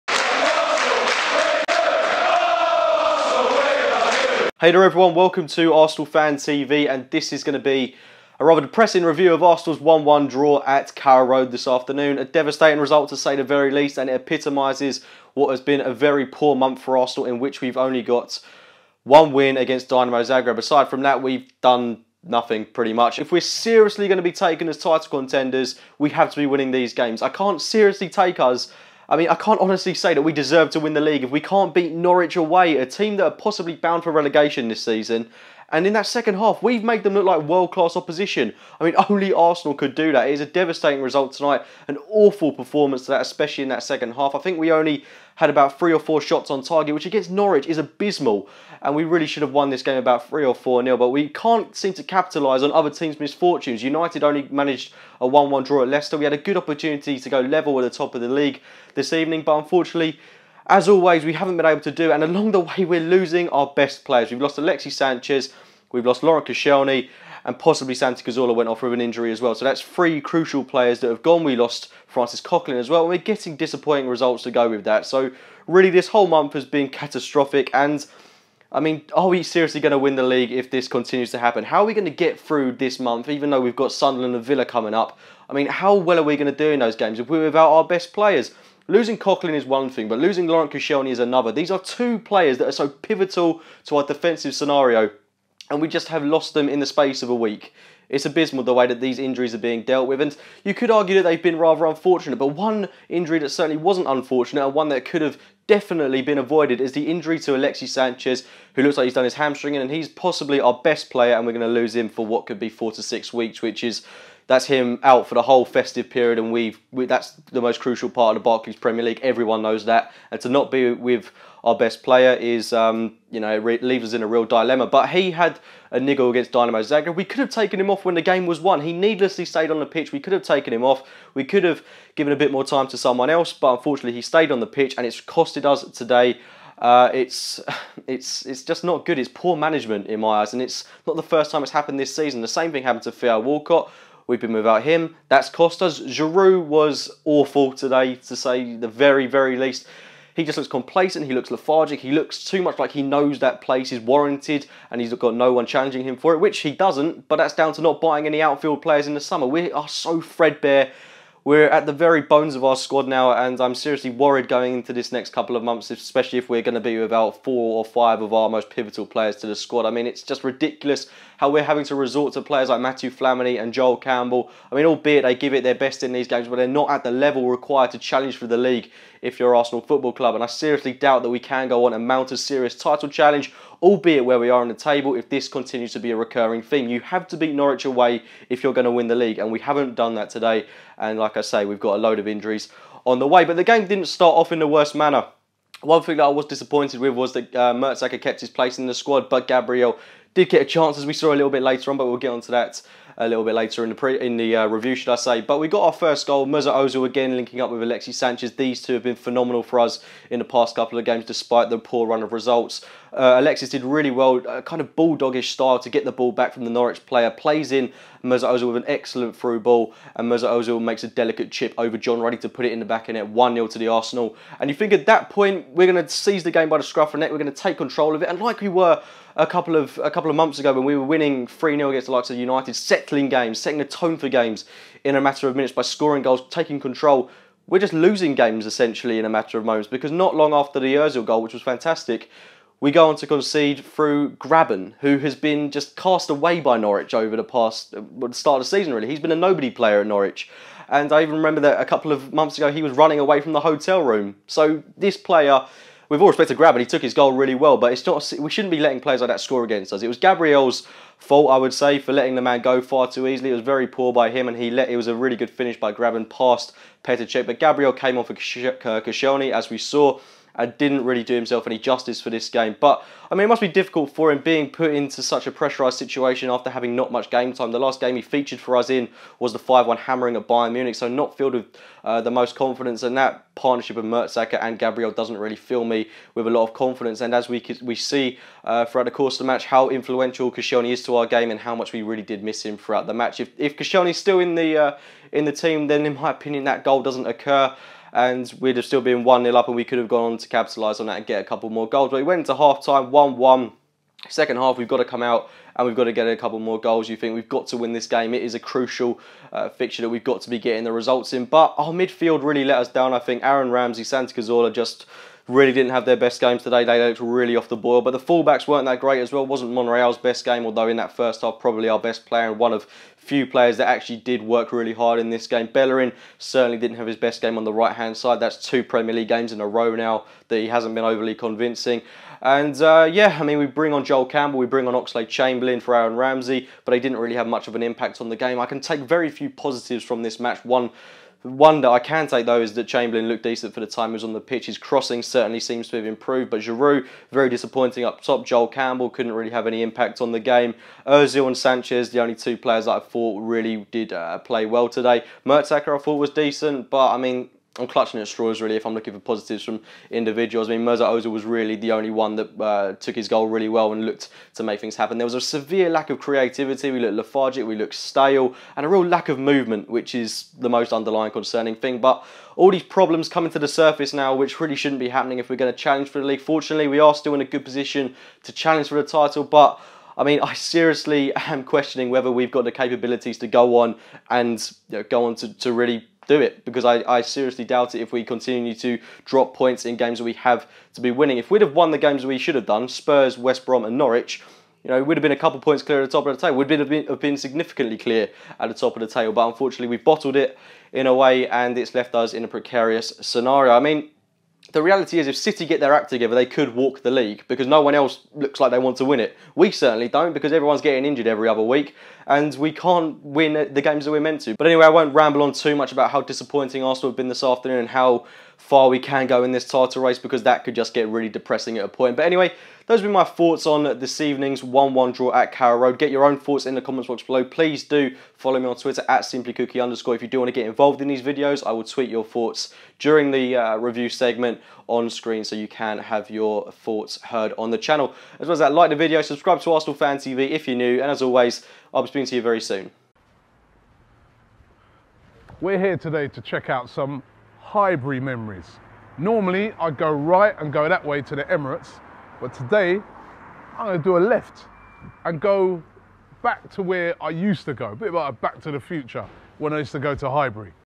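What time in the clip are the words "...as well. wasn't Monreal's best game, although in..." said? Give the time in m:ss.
5:19.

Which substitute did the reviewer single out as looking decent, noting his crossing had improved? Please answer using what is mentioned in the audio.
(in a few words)
Chamberlain.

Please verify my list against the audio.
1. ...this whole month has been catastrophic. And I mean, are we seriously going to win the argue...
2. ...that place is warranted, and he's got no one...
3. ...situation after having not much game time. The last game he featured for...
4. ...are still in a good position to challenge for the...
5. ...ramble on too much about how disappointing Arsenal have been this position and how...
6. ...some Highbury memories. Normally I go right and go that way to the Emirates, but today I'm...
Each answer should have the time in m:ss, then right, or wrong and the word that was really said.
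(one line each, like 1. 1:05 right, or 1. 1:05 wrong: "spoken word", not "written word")
1. 1:15 wrong: "league", not "argue"
2. 2:33 right
3. 4:35 right
4. 6:16 right
5. 6:55 wrong: "afternoon", not "position"
6. 7:26 right.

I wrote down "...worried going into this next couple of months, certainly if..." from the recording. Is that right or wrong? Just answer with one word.
wrong.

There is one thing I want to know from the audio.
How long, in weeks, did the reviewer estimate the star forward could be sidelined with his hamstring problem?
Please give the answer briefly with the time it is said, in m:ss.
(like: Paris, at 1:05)
4 to 6 weeks, at 1:52.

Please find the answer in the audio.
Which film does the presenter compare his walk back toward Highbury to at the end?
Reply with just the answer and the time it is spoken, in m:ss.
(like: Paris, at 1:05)
Back to the Future, at 7:38.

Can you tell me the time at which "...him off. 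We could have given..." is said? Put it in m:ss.
2:10.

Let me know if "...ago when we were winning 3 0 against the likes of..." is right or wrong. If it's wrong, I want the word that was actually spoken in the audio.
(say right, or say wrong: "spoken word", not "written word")
right.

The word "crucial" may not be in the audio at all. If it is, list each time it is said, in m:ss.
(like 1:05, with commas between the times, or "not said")
1:10, 1:57, 5:08.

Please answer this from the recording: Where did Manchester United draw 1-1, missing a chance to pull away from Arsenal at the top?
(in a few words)
Leicester.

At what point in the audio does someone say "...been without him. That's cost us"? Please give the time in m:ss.
2:24.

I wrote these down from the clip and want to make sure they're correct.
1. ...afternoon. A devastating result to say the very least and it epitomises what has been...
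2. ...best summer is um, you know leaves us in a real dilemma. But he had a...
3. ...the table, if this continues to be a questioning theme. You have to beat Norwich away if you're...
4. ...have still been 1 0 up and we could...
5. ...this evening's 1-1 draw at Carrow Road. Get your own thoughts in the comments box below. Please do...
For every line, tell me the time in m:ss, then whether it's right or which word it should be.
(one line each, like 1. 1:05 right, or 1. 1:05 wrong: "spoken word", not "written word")
1. 0:11 right
2. 2:01 wrong: "player", not "summer"
3. 3:04 wrong: "recurring", not "questioning"
4. 4:58 right
5. 7:03 right.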